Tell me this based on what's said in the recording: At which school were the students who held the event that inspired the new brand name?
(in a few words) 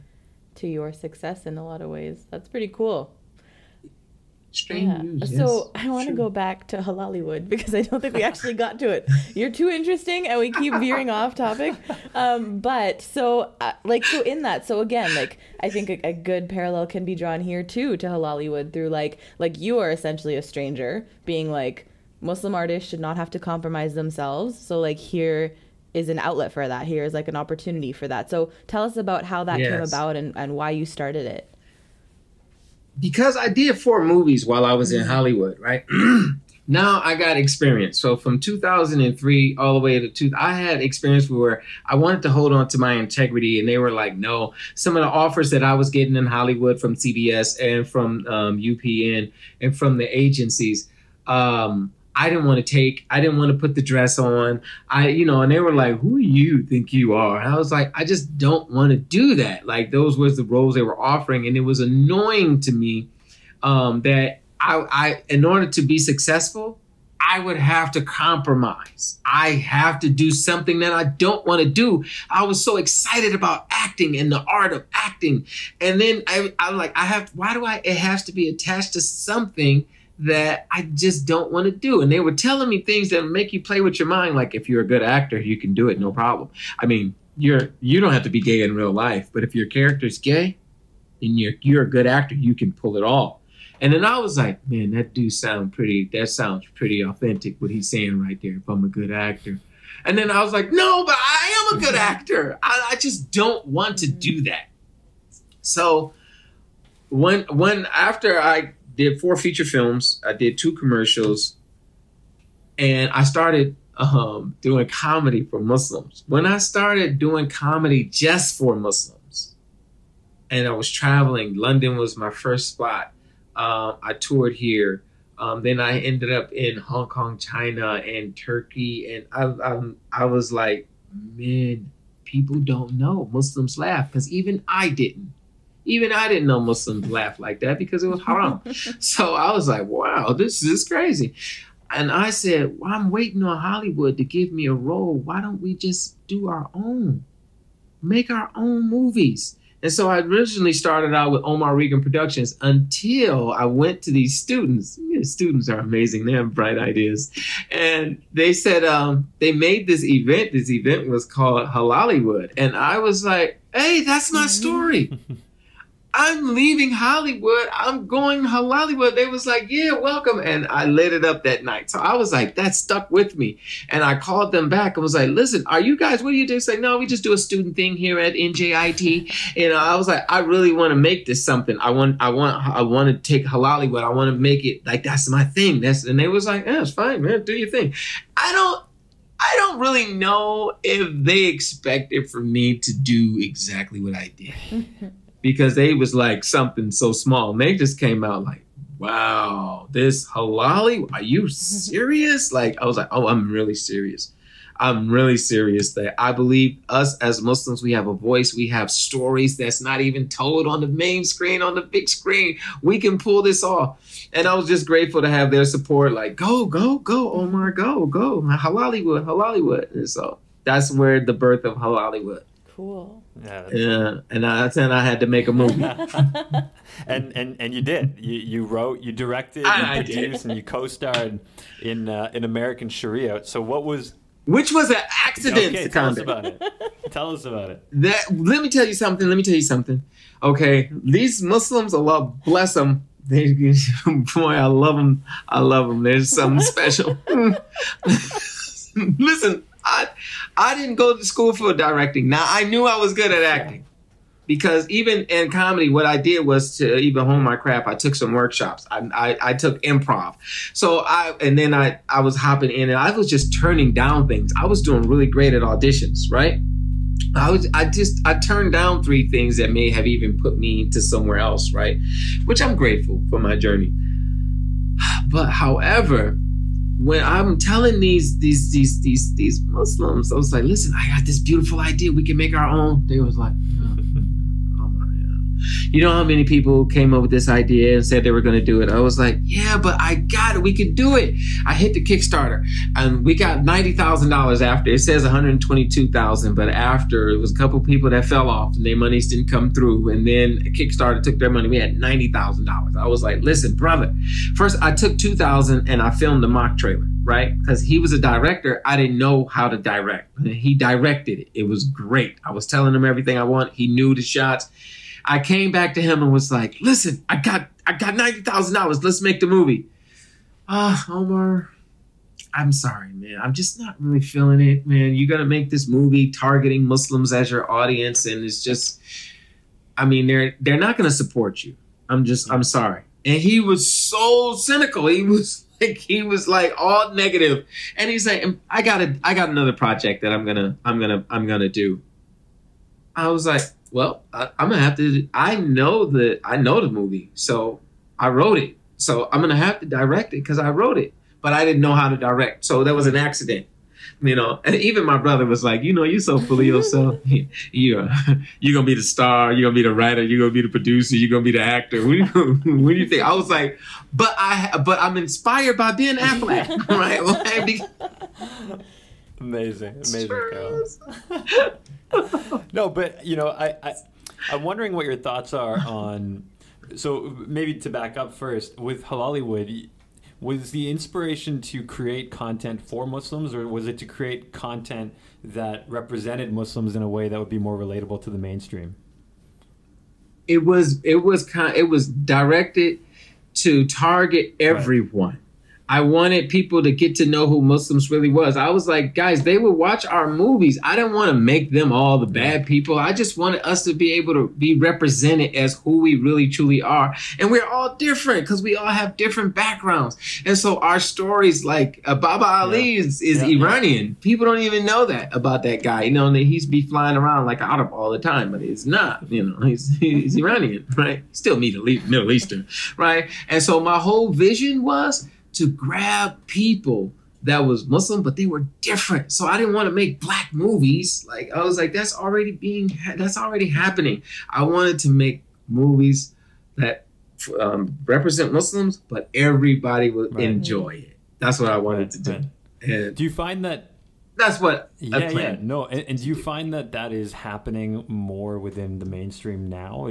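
NJIT.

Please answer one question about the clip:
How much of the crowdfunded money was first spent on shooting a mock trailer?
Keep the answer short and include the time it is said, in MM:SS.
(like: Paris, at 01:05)
2000, at 05:05.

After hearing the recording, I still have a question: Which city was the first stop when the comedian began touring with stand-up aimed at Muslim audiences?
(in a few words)
London.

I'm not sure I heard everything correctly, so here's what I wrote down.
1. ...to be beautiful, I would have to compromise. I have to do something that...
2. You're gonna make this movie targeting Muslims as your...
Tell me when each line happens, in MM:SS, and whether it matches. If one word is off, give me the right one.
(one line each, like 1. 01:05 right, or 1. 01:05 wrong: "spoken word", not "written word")
1. 01:05 wrong: "successful", not "beautiful"
2. 05:25 right.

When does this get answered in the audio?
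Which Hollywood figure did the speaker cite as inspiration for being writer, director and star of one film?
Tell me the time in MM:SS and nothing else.
06:05.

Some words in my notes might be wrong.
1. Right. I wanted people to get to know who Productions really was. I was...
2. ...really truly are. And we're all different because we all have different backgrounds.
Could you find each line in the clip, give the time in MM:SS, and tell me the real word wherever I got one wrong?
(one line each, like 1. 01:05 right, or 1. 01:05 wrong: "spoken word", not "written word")
1. 06:35 wrong: "Muslims", not "Productions"
2. 06:46 right.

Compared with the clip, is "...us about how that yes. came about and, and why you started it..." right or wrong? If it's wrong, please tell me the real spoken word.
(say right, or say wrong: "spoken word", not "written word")
right.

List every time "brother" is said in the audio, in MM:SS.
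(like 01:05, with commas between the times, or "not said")
05:03, 05:55.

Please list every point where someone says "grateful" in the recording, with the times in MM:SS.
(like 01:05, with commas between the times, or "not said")
03:34, 04:32.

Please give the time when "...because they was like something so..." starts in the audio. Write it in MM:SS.
03:15.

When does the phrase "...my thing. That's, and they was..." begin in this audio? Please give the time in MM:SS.
03:05.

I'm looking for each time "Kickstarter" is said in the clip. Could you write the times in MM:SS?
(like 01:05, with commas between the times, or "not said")
04:52, 05:00.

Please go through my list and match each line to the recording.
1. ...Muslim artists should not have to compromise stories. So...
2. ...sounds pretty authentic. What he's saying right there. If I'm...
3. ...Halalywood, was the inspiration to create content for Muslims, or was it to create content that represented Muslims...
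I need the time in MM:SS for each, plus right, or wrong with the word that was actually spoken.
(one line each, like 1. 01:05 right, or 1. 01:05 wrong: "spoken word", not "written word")
1. 00:22 wrong: "themselves", not "stories"
2. 01:36 right
3. 06:19 right.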